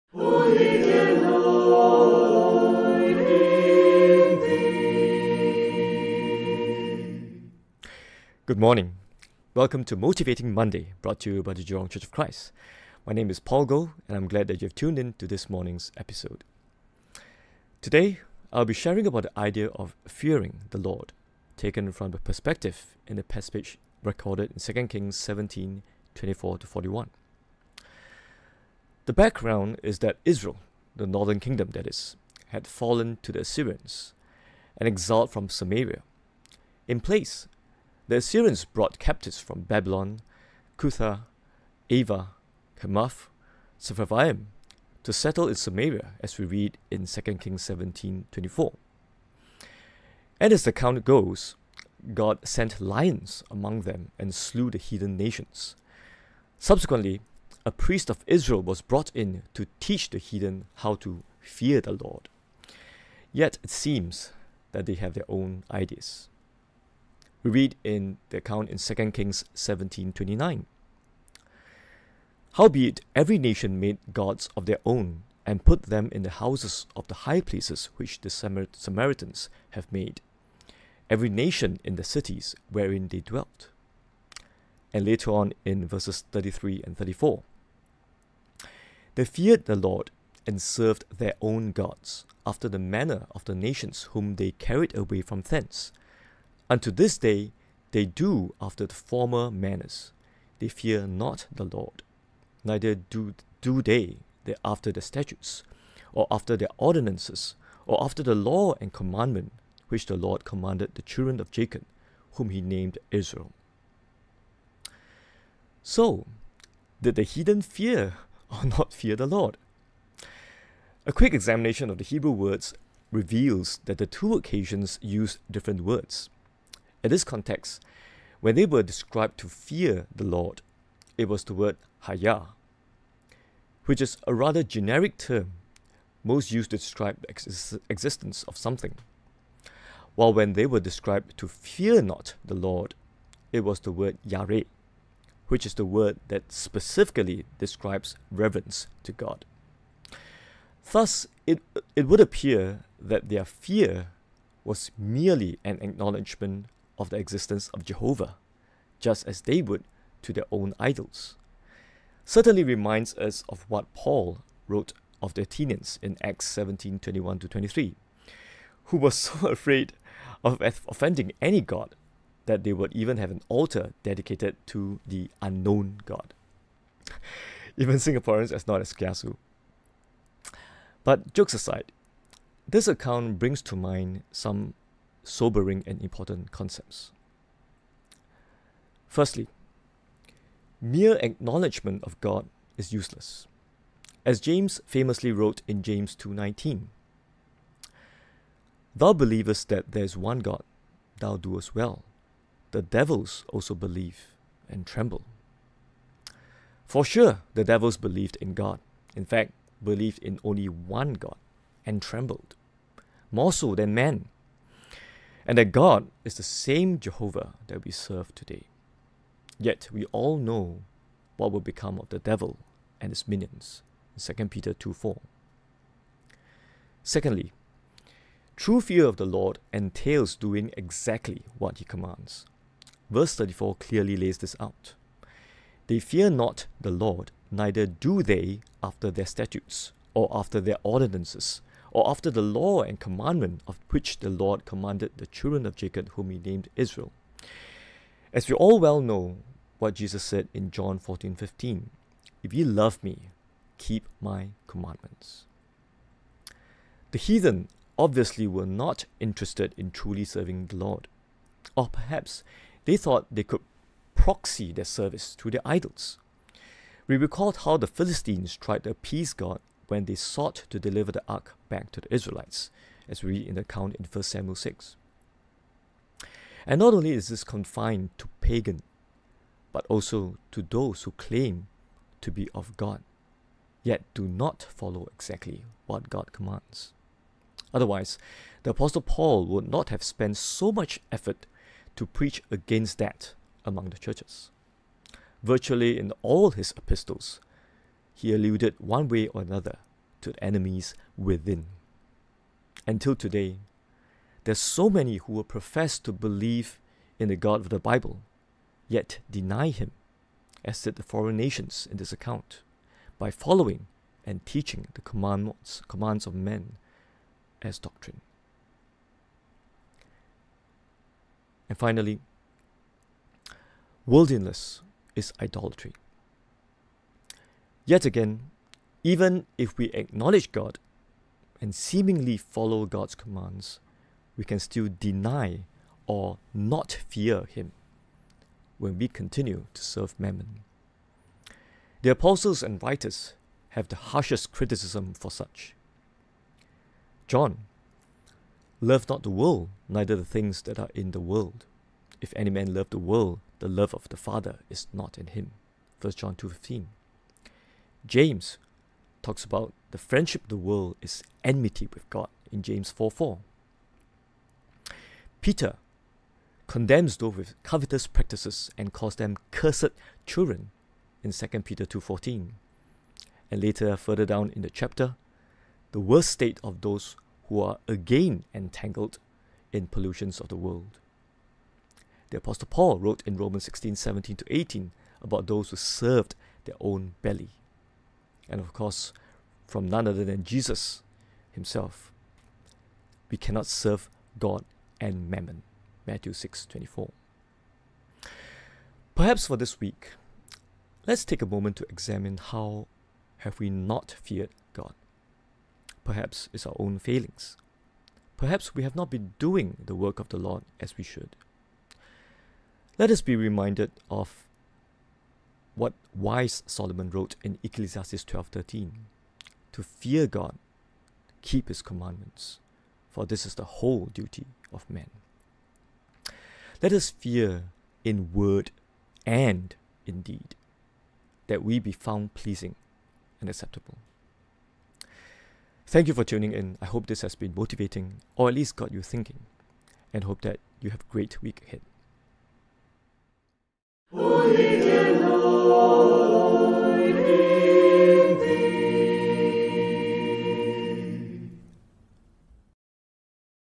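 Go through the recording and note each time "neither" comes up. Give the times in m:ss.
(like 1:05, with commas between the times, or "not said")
1:42, 3:57, 5:49.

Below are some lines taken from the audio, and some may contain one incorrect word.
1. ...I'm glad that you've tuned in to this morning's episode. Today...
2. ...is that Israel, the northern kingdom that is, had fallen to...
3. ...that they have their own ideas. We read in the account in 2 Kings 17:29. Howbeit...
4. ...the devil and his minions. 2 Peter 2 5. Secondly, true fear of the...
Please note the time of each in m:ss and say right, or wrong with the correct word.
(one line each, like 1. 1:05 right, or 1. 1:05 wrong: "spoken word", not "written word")
1. 0:14 right
2. 0:29 right
3. 1:04 right
4. 3:42 wrong: "4", not "5".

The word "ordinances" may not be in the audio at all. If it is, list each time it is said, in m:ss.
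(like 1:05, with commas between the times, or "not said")
1:46, 4:00.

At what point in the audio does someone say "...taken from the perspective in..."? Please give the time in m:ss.
0:21.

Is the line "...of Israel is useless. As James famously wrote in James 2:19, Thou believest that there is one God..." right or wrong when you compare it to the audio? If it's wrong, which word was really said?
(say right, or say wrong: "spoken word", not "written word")
wrong: "God", not "Israel".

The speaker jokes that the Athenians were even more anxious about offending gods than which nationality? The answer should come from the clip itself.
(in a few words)
Singaporeans.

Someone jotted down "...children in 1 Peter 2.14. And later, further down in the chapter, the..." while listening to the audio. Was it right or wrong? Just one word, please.
wrong.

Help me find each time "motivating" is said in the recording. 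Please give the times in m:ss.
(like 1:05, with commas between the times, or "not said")
0:09, 7:17.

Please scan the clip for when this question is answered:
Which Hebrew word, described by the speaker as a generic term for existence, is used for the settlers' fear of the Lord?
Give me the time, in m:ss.
2:12.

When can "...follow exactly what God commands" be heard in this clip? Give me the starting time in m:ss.
4:44.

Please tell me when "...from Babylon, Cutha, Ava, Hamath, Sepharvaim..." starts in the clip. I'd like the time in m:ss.
0:39.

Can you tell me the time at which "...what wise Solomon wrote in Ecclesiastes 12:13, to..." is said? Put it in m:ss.
6:55.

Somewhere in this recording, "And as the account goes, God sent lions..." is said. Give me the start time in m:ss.
0:50.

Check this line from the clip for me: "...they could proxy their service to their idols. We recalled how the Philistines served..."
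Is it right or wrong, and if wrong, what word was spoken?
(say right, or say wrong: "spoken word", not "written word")
wrong: "tried", not "served".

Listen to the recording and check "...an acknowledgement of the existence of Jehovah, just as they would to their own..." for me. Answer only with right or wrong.
right.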